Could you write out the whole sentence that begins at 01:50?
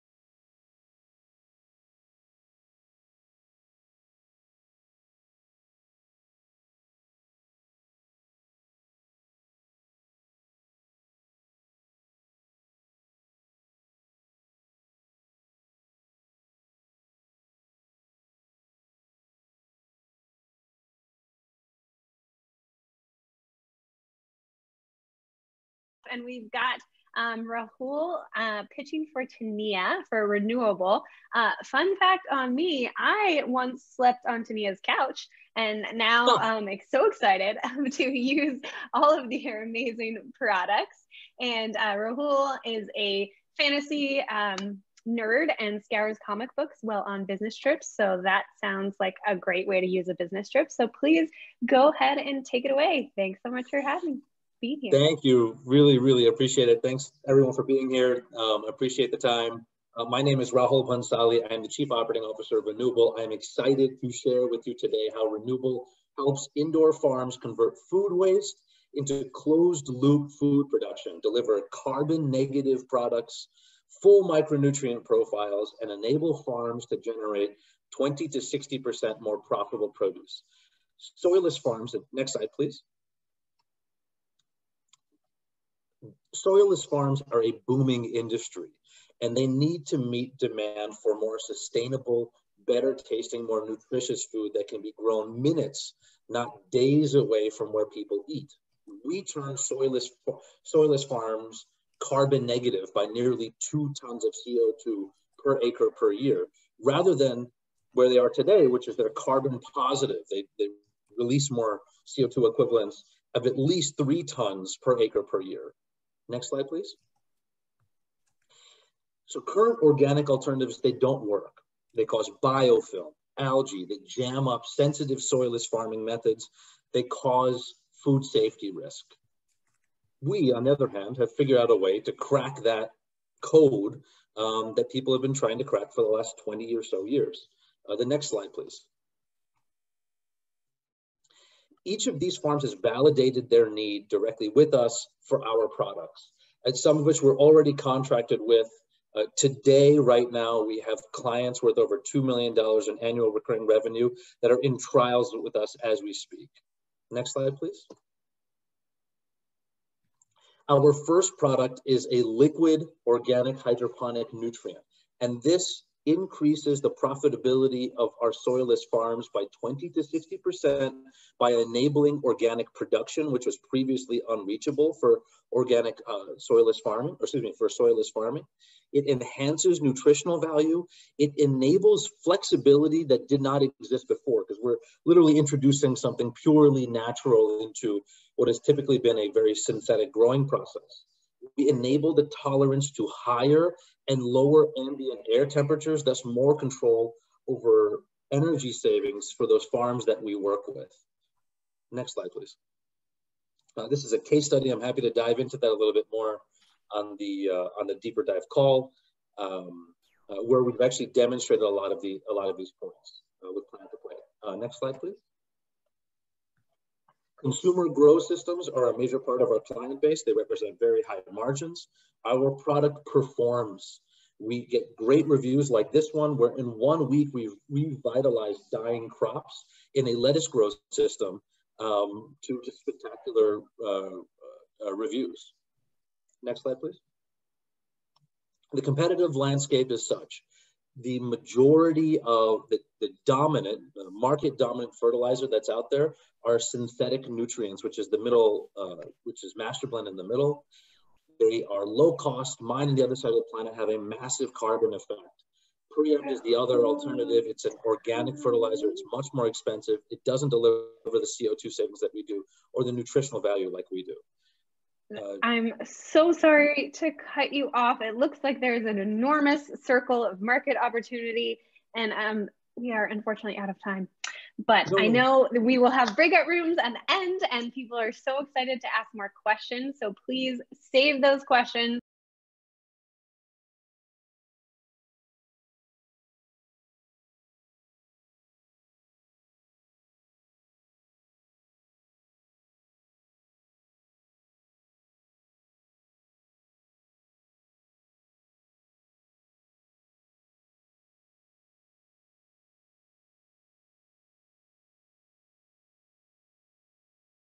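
They, they release more CO2 equivalents of at least three tons per acre per year.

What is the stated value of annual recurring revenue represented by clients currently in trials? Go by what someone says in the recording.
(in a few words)
Over $2 million.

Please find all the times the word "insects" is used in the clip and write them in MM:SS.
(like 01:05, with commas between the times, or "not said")
not said.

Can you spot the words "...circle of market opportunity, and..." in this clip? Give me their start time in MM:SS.
04:29.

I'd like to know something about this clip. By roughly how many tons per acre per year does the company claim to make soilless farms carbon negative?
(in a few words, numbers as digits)
2 tons.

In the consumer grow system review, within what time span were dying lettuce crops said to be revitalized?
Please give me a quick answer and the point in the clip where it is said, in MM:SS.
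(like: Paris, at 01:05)
One week, at 03:46.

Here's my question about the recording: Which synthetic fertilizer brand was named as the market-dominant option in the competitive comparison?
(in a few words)
Master Blend.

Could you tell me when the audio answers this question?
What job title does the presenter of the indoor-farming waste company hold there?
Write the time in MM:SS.
01:01.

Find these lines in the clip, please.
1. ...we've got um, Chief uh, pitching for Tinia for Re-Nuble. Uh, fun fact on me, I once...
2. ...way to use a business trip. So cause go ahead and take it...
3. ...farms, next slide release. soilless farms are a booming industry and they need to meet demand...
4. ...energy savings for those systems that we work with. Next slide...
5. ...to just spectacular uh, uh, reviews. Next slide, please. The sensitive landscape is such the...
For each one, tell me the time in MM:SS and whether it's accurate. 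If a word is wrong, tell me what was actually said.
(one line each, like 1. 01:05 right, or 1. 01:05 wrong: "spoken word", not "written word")
1. 00:26 wrong: "Rahul", not "Chief"
2. 00:49 wrong: "please", not "cause"
3. 01:21 wrong: "please", not "release"
4. 03:18 wrong: "farms", not "systems"
5. 03:52 wrong: "competitive", not "sensitive".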